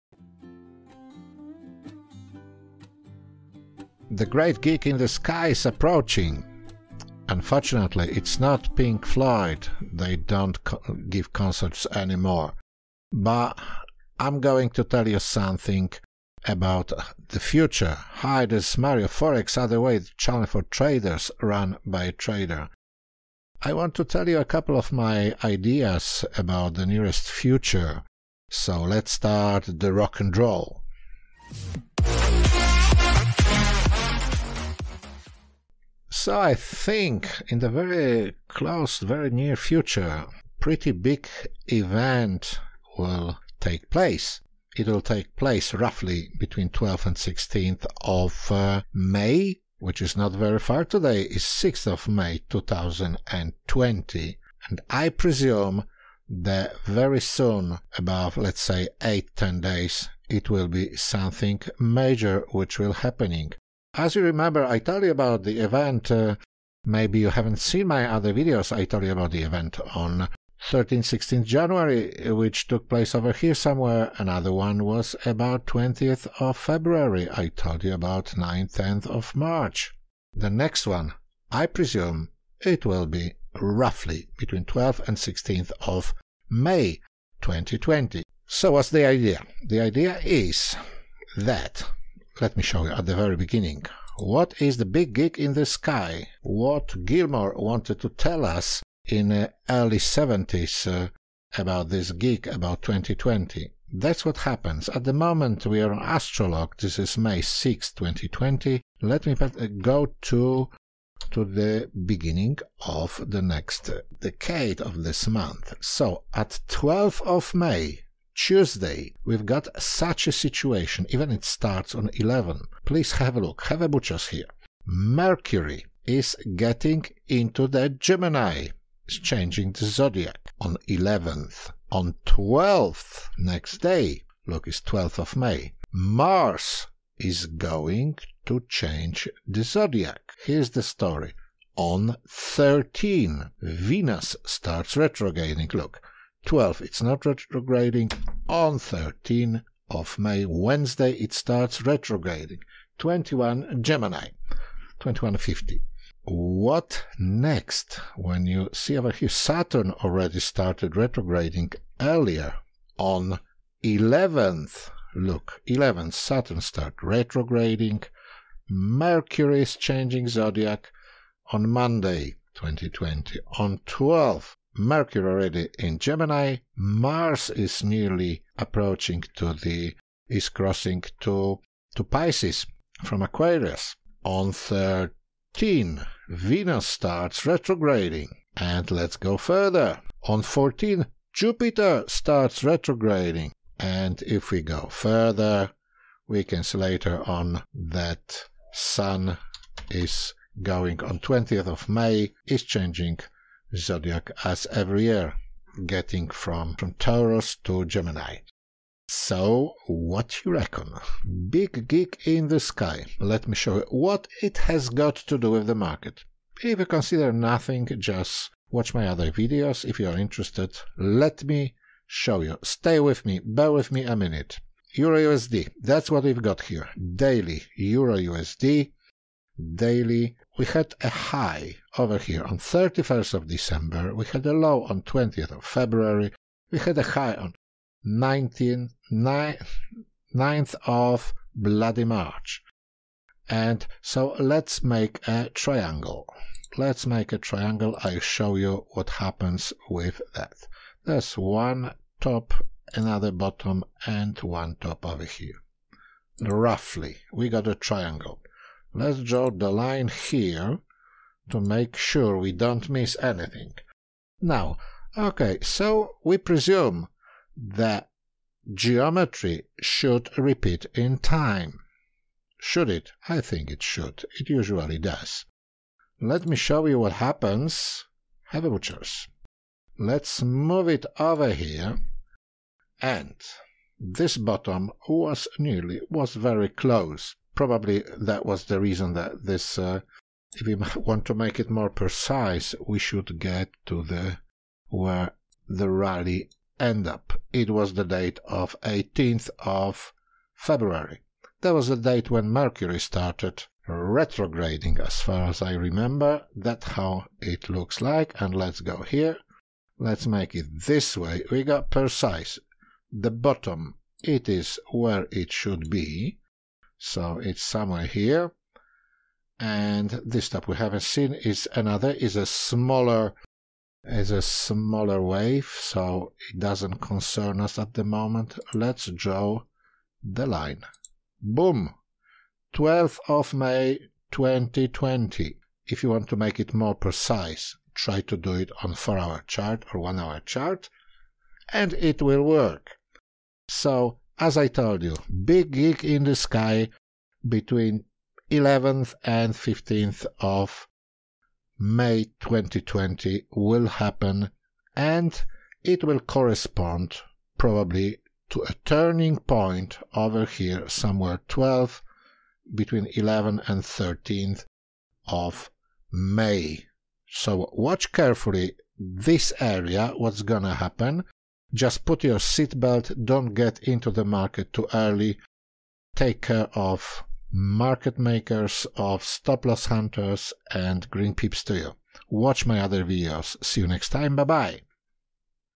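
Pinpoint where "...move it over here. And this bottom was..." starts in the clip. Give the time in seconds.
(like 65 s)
280 s.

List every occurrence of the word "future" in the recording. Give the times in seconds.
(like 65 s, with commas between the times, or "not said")
17 s, 27 s, 39 s.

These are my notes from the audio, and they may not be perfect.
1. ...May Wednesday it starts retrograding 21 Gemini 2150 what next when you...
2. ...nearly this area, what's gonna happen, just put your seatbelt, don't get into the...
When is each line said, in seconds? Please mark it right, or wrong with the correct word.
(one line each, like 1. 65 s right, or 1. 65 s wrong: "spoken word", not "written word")
1. 150 s right
2. 368 s wrong: "carefully", not "nearly".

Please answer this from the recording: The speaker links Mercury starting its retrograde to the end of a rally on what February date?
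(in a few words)
18th of February.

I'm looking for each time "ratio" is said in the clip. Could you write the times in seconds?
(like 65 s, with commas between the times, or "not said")
not said.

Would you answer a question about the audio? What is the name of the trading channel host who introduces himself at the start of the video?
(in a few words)
Mario Forex.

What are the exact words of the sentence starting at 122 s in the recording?
Please have a look, have a butcher's here.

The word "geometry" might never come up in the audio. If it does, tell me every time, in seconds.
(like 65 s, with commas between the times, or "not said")
268 s.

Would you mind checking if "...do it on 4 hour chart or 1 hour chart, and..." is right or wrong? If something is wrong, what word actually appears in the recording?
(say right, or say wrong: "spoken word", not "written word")
right.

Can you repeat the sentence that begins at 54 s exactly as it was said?
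And I presume that very soon, above let's say 8-10 days, it will be something major which will happening.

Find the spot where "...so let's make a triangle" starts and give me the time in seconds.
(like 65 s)
244 s.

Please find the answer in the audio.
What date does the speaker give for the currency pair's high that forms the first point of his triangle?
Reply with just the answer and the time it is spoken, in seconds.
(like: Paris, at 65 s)
31st of December, at 232 s.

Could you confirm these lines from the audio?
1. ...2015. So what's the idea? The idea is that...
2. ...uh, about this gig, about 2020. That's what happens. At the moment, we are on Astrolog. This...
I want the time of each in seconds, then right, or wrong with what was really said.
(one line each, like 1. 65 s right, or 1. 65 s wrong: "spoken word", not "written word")
1. 87 s wrong: "2020", not "2015"
2. 100 s right.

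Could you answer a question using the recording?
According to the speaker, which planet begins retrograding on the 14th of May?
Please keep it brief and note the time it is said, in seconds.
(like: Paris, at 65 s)
Jupiter, at 191 s.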